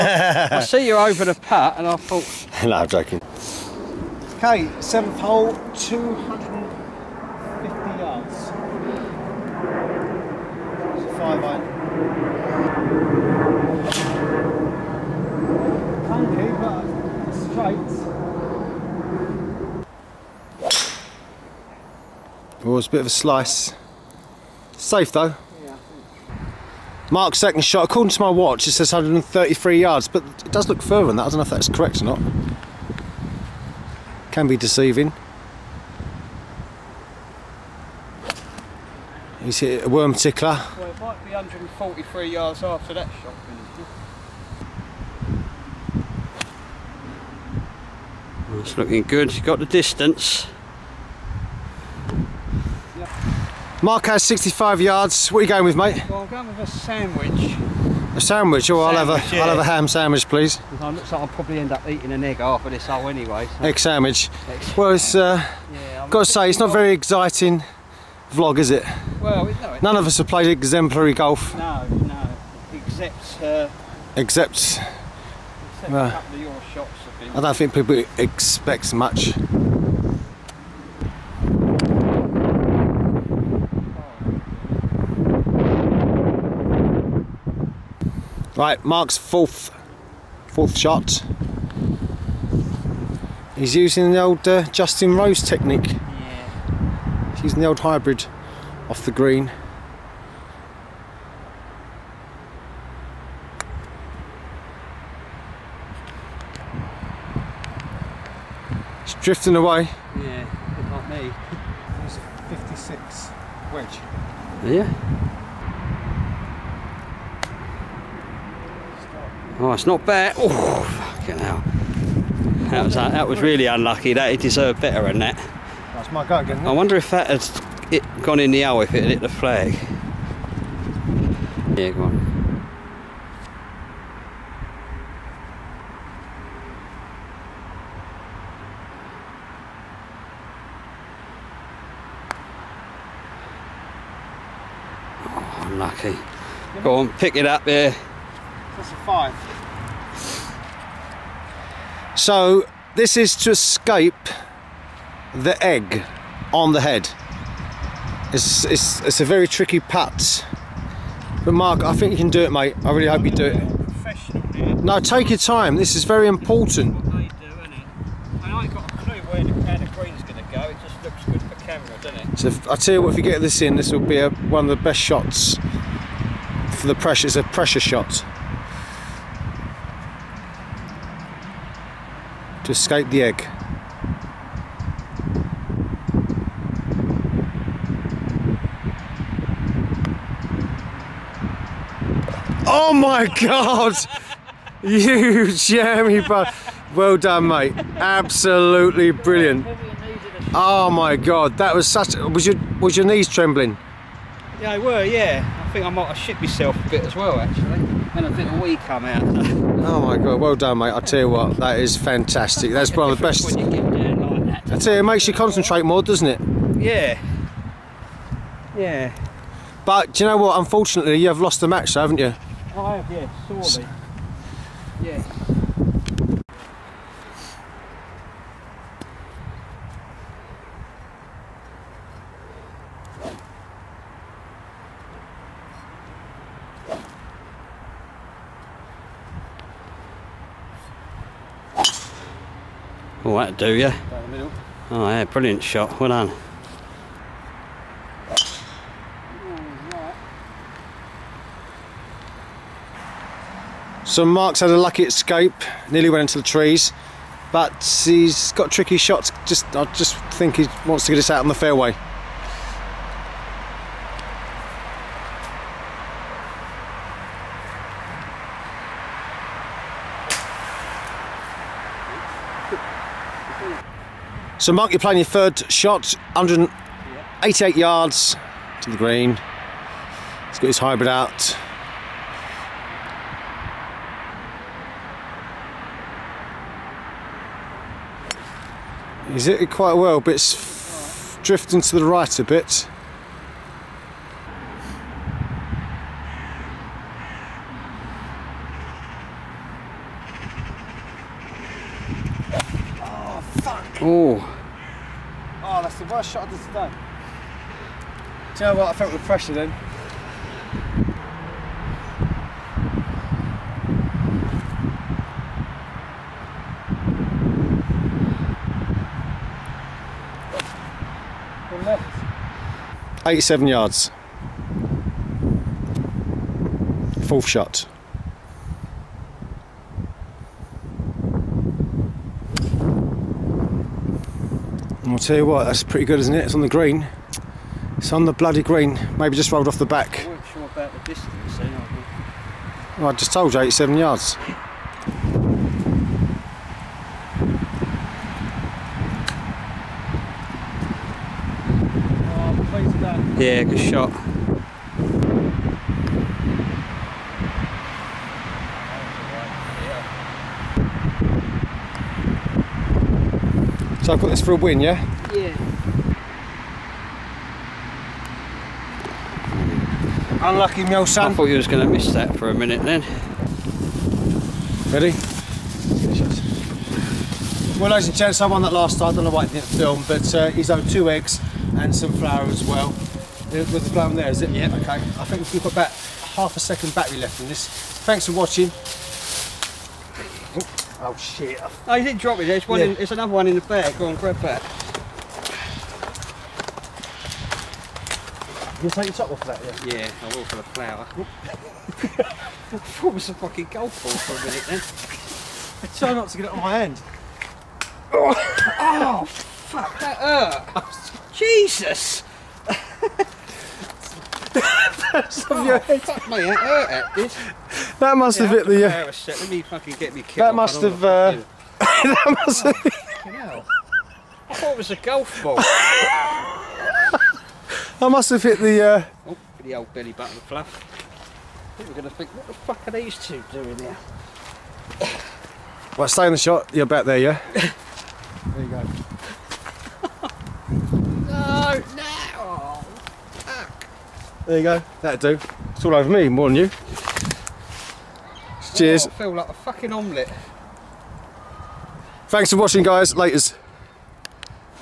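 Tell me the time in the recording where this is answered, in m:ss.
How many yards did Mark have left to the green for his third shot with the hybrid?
4:36.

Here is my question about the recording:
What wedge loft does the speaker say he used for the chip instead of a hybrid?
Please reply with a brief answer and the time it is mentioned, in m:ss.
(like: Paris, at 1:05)
56, at 1:52.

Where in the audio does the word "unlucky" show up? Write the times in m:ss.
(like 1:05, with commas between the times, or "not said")
2:03, 2:25, 6:10.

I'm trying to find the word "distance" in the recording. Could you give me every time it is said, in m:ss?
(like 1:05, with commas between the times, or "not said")
0:49, 5:40.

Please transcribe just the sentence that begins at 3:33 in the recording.
Like that, I tell you, it makes you concentrate more, doesn't it?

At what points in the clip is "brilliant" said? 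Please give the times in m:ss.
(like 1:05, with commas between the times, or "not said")
3:19, 4:05.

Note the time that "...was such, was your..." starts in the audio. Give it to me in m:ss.
3:21.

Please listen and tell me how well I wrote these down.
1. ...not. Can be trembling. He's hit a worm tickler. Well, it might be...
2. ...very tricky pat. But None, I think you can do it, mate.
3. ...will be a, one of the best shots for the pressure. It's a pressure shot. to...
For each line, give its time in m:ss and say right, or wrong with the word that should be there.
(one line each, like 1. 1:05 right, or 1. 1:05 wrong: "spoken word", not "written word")
1. 0:32 wrong: "deceiving", not "trembling"
2. 2:39 wrong: "Mark", not "None"
3. 2:53 right.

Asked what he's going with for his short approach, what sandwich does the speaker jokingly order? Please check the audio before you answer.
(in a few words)
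Ham sandwich.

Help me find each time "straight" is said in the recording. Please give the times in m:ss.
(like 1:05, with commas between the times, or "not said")
0:17.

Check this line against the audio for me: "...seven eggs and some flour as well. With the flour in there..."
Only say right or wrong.
wrong.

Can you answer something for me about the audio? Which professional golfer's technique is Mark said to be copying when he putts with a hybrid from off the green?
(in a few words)
Justin Rose.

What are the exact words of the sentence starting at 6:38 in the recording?
You take your top off that, yeah?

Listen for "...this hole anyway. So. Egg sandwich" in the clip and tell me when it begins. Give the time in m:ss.
1:02.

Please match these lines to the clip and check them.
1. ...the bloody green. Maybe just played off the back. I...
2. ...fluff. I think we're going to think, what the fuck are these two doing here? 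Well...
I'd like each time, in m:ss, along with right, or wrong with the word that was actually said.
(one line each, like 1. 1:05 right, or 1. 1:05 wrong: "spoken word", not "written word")
1. 5:38 wrong: "rolled", not "played"
2. 7:10 right.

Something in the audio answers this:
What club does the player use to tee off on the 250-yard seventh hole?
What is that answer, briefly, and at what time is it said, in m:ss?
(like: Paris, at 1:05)
5 iron, at 0:11.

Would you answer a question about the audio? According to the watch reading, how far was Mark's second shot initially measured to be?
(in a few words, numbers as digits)
133 yards.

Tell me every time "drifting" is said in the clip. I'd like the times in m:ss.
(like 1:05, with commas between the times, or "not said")
1:49, 4:51.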